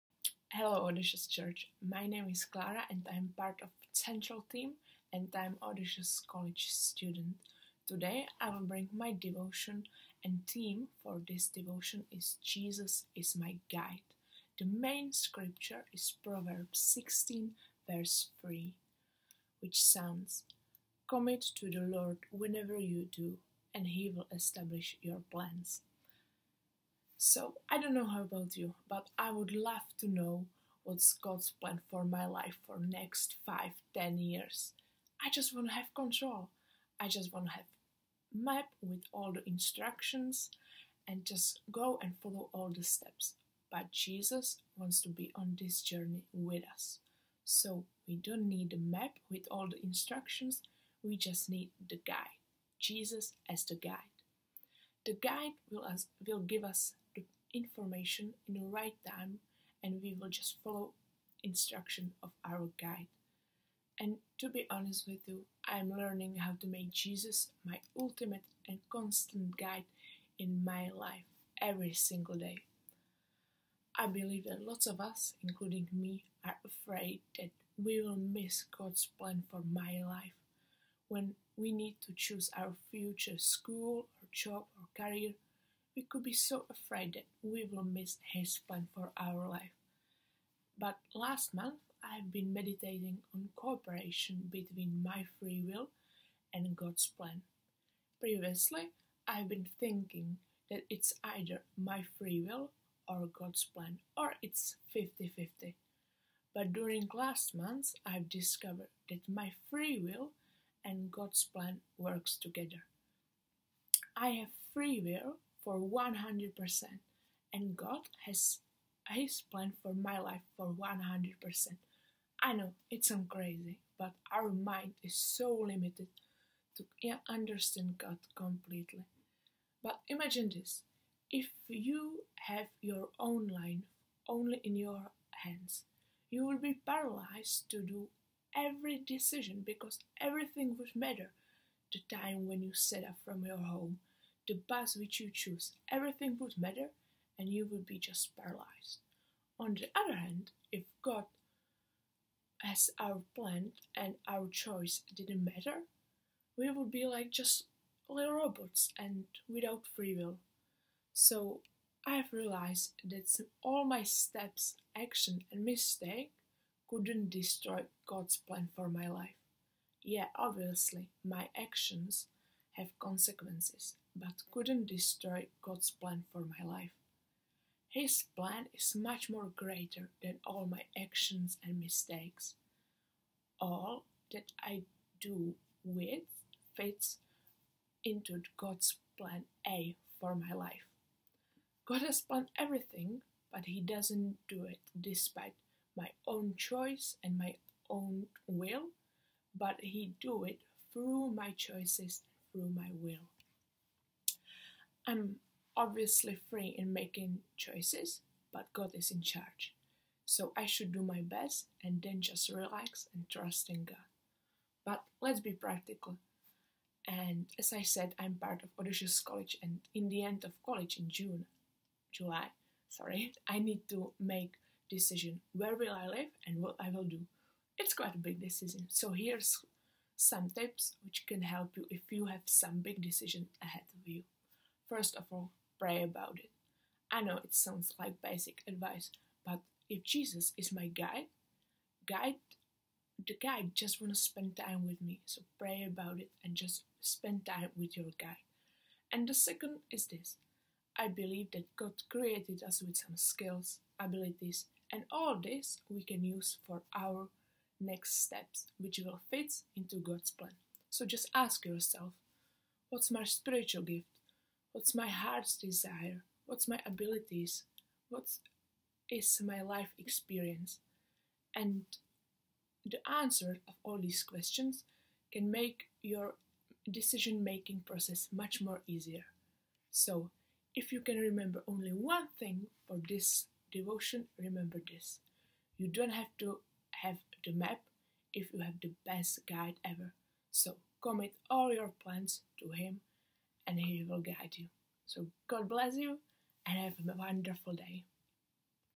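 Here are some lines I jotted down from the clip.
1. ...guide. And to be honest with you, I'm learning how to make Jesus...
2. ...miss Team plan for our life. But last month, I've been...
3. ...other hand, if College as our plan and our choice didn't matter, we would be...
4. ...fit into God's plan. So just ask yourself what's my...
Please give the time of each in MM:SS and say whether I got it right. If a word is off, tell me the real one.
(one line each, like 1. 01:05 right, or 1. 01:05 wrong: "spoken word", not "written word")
1. 01:02 right
2. 01:27 wrong: "His", not "Team"
3. 02:29 wrong: "God", not "College"
4. 04:19 right.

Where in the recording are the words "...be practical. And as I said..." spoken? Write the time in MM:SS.
03:35.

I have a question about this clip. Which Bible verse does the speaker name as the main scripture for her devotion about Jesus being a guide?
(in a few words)
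Proverbs 16:3.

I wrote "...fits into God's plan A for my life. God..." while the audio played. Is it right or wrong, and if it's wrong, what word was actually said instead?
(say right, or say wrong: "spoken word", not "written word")
right.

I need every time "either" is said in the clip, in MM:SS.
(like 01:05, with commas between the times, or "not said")
01:41.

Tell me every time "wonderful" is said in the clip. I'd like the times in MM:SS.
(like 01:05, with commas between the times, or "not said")
04:57.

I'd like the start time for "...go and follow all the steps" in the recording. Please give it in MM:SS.
00:41.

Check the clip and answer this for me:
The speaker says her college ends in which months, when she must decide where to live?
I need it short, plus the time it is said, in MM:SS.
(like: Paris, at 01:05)
June, July, at 03:41.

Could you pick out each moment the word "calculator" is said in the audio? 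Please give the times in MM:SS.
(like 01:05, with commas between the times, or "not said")
not said.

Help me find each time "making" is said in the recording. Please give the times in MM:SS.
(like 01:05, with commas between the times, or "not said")
03:26, 04:37.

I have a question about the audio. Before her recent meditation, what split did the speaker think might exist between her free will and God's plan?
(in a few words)
50 50.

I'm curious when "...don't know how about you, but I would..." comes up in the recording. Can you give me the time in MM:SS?
00:27.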